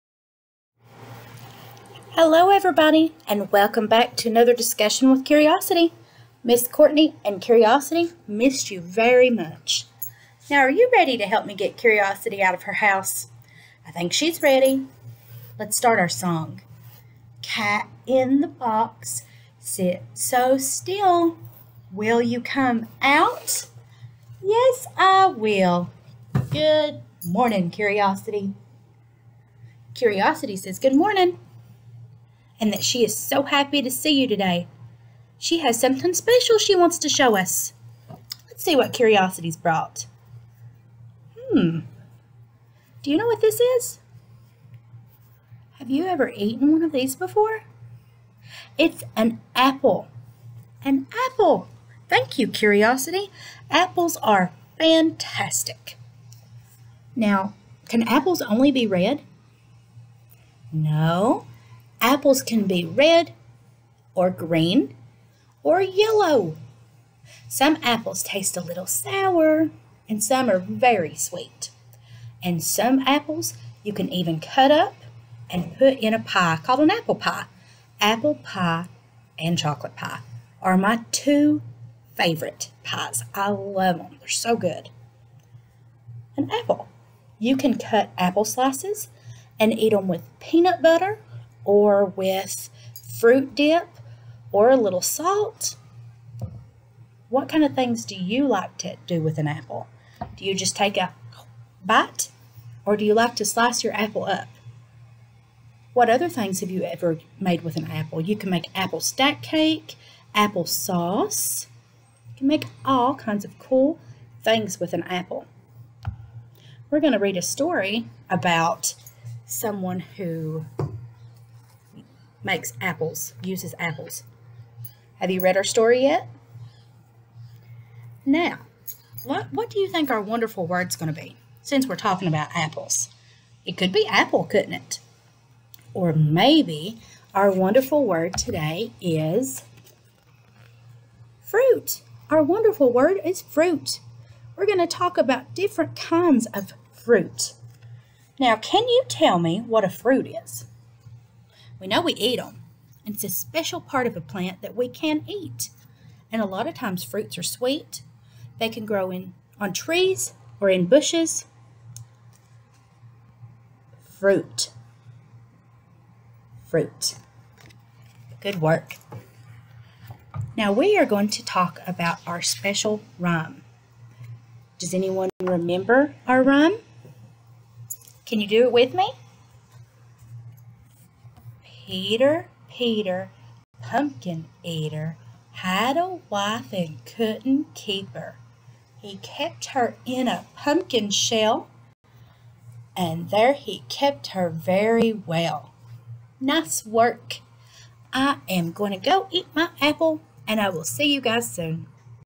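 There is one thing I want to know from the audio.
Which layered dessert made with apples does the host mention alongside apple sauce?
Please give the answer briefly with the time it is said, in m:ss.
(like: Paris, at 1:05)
apple stack cake, at 1:48.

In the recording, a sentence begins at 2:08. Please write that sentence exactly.
Now, what, what do you think our wonderful word's going to be since we're talking about apples?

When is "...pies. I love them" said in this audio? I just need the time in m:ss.
1:22.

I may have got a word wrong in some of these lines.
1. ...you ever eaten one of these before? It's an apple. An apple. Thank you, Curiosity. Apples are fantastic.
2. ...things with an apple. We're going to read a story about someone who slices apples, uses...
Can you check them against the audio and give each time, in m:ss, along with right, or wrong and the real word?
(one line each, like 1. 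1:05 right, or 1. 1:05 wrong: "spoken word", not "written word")
1. 0:45 right
2. 1:54 wrong: "makes", not "slices".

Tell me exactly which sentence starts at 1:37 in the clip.
What kind of things do you like to do with an apple?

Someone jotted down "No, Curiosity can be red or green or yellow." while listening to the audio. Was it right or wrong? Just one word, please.
wrong.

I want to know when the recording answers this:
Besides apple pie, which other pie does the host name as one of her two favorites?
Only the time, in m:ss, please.
1:19.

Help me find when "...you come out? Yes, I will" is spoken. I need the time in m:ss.
0:22.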